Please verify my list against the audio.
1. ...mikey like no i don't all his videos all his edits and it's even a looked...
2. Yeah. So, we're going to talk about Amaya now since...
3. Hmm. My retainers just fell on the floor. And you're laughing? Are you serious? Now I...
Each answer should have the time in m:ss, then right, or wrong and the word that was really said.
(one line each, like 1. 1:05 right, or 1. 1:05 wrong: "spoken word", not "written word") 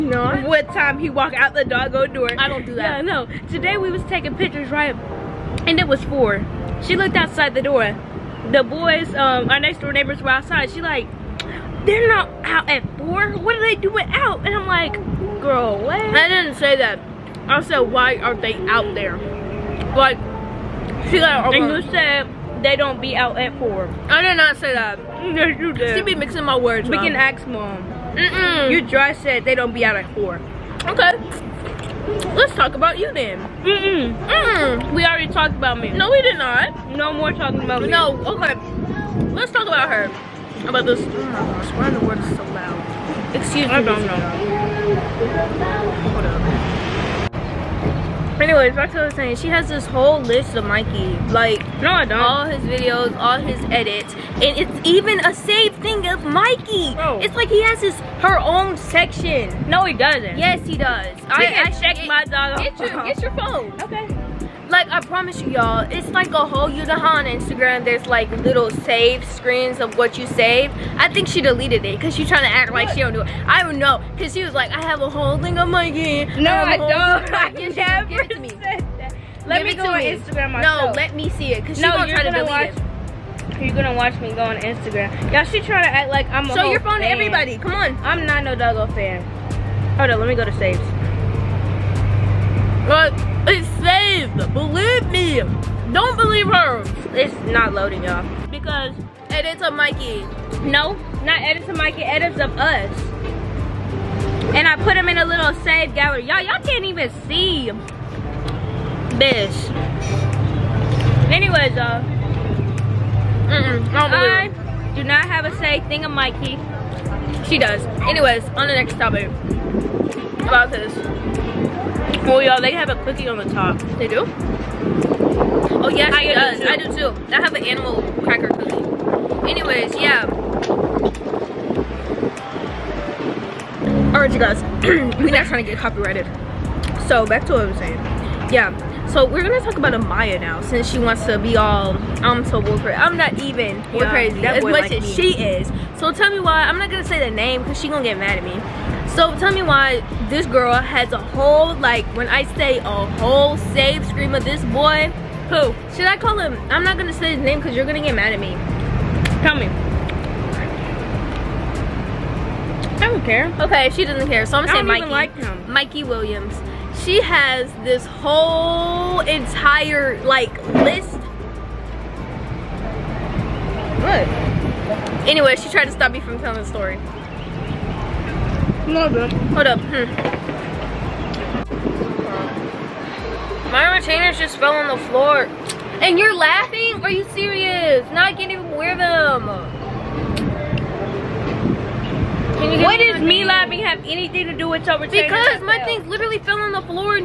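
1. 0:50 wrong: "saved", not "looked"
2. 2:18 right
3. 2:59 right.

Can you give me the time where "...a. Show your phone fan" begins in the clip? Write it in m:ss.
1:26.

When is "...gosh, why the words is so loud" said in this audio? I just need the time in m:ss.
0:41.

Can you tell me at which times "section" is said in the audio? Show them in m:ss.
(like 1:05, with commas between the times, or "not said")
0:58.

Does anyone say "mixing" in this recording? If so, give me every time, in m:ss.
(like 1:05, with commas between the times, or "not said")
0:26.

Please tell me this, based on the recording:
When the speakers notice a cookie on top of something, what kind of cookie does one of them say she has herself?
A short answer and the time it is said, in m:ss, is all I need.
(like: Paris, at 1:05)
Animal cracker cookie, at 2:07.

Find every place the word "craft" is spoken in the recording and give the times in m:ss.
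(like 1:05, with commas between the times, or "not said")
not said.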